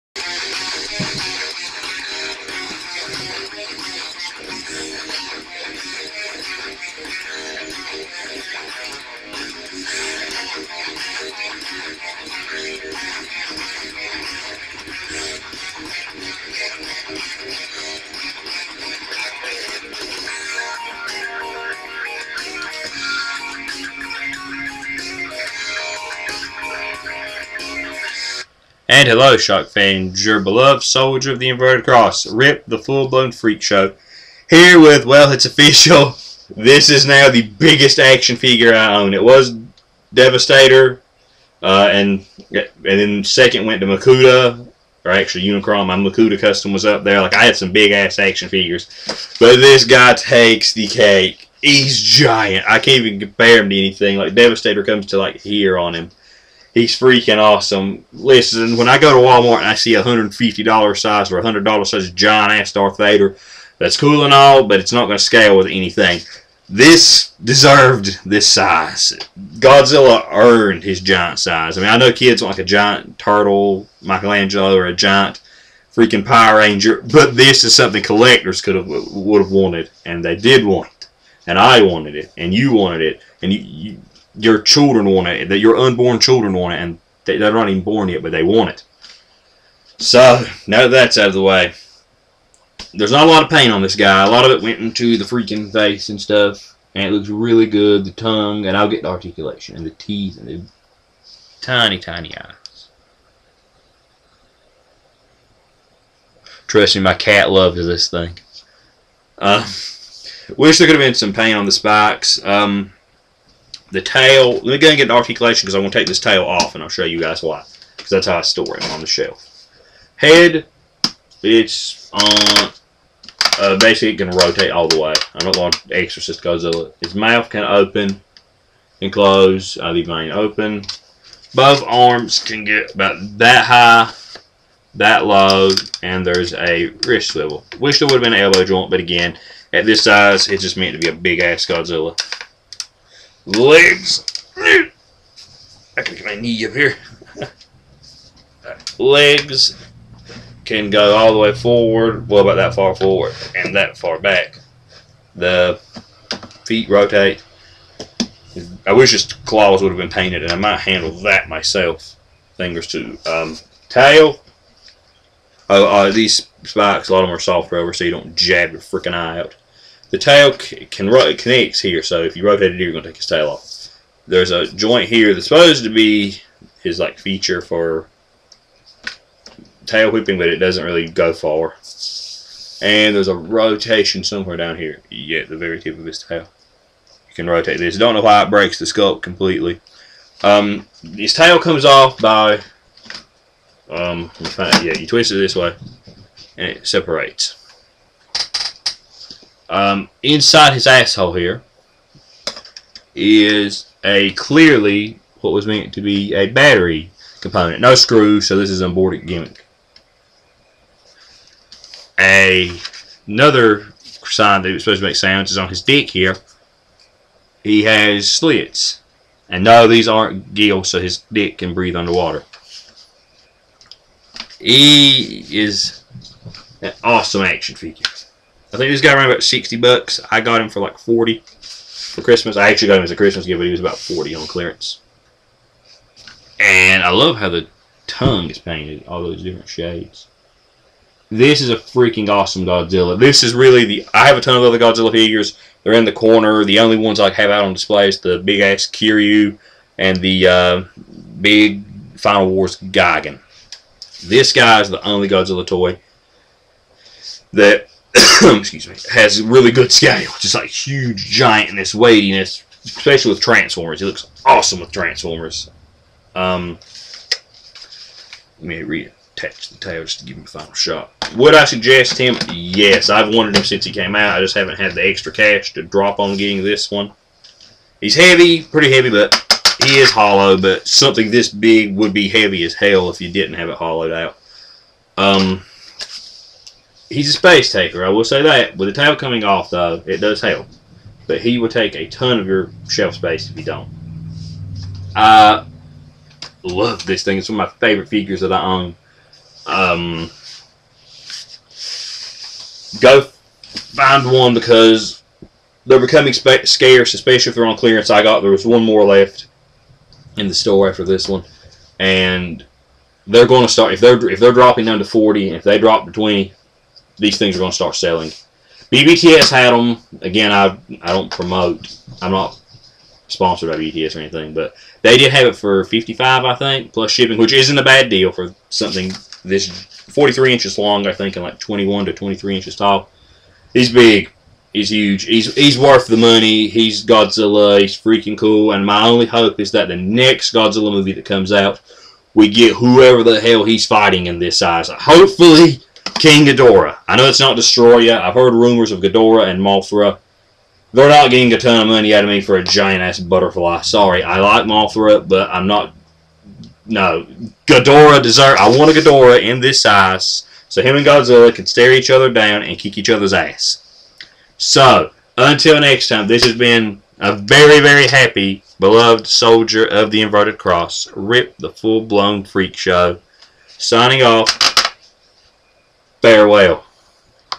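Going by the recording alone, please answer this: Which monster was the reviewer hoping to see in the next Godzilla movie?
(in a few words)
Destoroyah.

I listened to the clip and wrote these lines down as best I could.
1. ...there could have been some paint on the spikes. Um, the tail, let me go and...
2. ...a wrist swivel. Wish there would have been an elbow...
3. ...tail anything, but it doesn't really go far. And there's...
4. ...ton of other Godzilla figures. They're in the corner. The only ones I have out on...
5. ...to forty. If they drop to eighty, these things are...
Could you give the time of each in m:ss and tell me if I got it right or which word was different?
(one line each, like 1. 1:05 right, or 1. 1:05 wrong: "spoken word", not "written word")
1. 1:50 right
2. 2:16 right
3. 2:59 wrong: "whipping", not "anything"
4. 4:04 right
5. 5:14 wrong: "twenty", not "eighty".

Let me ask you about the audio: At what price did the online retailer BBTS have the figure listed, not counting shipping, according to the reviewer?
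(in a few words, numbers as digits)
$55.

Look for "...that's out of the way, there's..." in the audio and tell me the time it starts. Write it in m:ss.
1:30.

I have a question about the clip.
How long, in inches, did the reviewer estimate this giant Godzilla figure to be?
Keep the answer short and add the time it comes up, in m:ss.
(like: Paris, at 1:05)
43 inches, at 5:29.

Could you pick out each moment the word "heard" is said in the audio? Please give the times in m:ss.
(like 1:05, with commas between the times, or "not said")
5:48.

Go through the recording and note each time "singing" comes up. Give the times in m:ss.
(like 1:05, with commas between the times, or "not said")
not said.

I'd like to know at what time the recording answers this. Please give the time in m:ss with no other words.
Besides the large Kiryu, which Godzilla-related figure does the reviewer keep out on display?
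4:12.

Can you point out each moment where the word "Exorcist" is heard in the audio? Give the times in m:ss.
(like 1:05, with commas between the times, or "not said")
2:05.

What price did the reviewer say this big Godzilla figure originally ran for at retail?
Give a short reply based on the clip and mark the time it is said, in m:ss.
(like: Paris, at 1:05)
$60, at 3:49.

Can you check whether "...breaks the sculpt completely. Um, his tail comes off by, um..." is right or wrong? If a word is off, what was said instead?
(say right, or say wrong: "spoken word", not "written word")
right.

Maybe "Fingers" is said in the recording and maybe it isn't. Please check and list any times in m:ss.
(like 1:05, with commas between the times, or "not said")
2:42.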